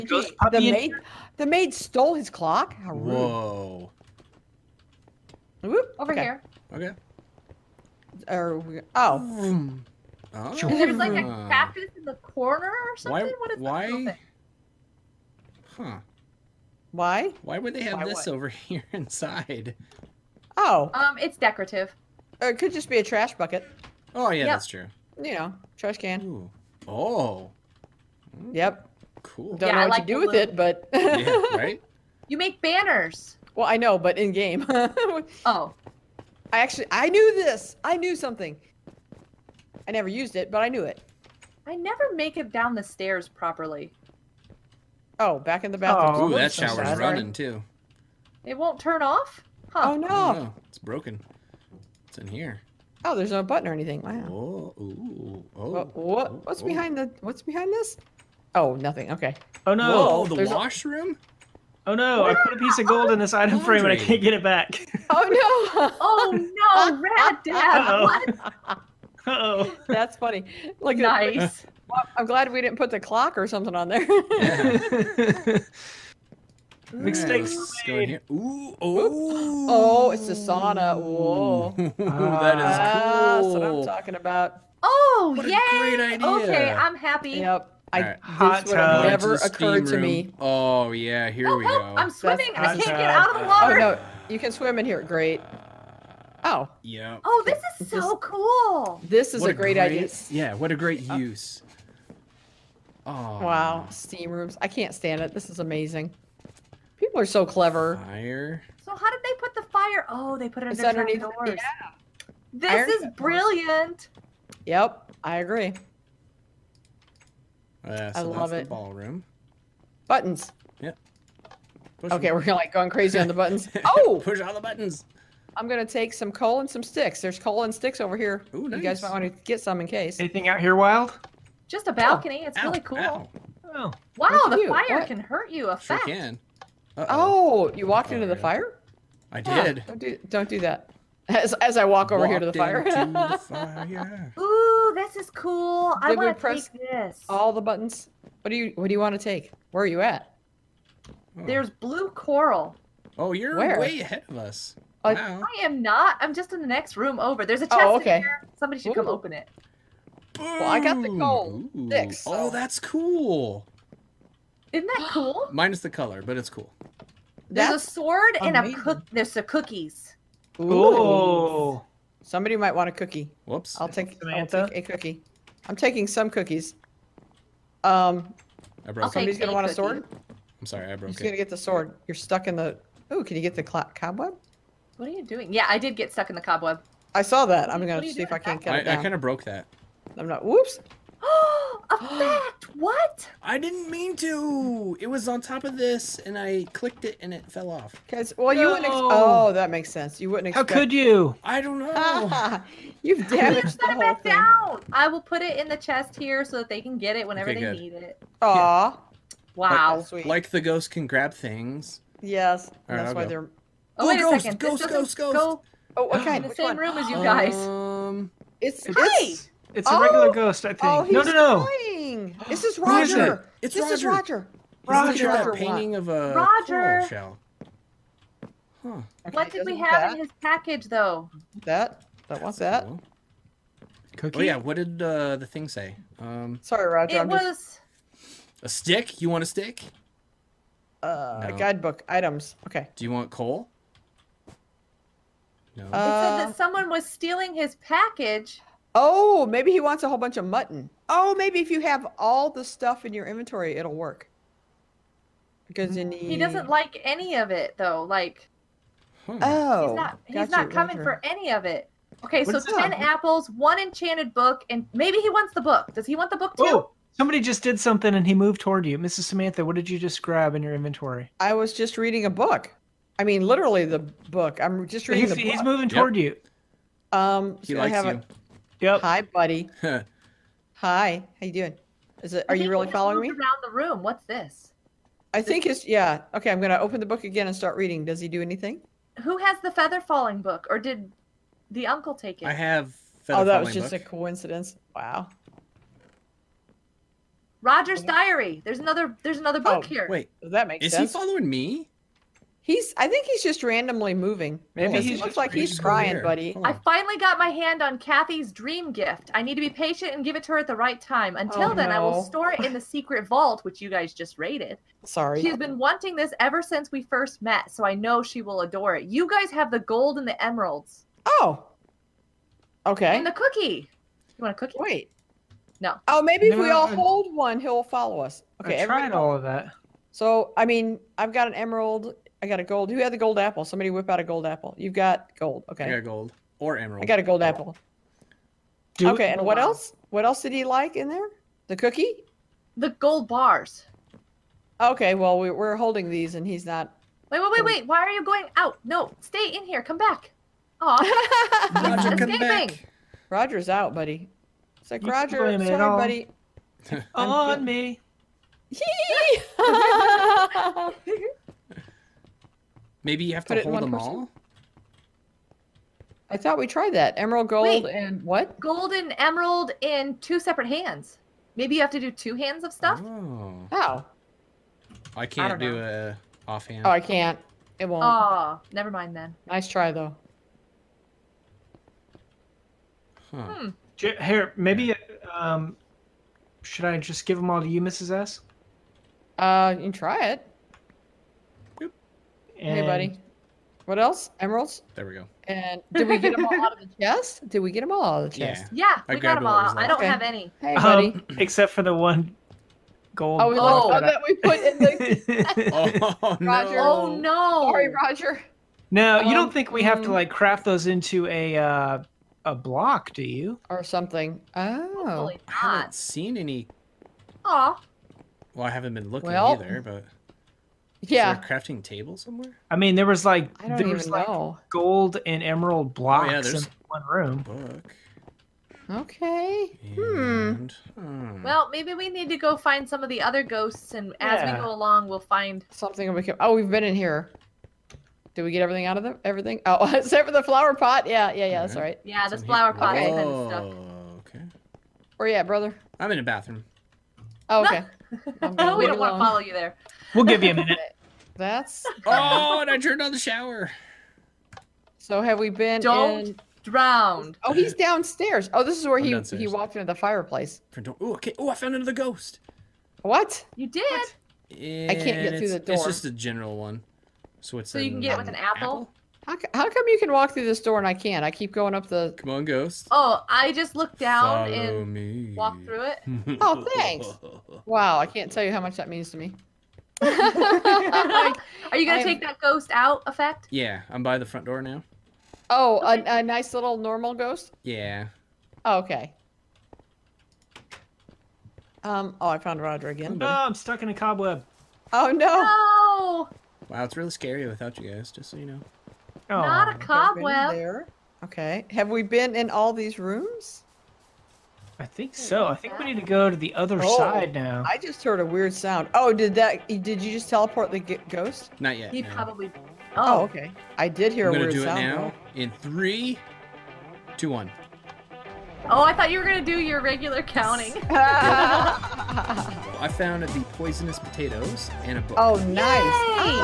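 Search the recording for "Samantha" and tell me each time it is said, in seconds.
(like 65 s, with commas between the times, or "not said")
174 s, 269 s.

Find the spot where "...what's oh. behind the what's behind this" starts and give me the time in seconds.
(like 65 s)
56 s.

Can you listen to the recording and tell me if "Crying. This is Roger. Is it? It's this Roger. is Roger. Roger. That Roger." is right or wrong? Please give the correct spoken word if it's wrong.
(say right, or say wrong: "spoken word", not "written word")
right.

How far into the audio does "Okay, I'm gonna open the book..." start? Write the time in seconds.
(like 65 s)
286 s.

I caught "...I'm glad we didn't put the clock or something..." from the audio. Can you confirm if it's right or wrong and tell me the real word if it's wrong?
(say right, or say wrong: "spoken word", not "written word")
right.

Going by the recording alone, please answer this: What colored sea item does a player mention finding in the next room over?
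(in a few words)
Blue coral.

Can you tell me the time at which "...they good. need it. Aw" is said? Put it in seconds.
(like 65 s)
207 s.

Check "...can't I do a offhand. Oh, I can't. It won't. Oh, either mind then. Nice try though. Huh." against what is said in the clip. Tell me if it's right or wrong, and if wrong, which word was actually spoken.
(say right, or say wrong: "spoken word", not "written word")
wrong: "never", not "either".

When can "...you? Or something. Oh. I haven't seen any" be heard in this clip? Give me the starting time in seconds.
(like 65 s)
413 s.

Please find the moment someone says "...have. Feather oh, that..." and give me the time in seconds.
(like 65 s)
292 s.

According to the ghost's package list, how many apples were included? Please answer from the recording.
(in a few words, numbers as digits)
10.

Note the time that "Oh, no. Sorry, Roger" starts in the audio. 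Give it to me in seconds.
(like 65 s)
406 s.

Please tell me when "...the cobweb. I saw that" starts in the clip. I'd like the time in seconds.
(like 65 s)
186 s.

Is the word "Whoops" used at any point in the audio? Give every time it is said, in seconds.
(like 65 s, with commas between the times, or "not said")
5 s, 173 s, 190 s.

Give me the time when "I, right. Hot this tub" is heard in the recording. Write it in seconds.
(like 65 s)
87 s.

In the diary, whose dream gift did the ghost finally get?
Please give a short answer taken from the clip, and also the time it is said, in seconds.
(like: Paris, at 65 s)
Kathy, at 307 s.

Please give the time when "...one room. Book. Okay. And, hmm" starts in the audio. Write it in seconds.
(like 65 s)
426 s.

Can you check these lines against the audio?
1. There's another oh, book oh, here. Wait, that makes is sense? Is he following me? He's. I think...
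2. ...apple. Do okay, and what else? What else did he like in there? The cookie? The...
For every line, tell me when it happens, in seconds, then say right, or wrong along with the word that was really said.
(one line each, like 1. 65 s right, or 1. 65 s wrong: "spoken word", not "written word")
1. 299 s right
2. 337 s right.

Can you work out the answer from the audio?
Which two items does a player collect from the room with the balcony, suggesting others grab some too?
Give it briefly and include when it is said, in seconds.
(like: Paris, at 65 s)
Coal and sticks, at 127 s.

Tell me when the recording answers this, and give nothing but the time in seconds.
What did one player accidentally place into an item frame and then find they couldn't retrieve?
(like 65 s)
62 s.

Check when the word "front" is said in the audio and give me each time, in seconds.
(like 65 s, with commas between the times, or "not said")
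484 s.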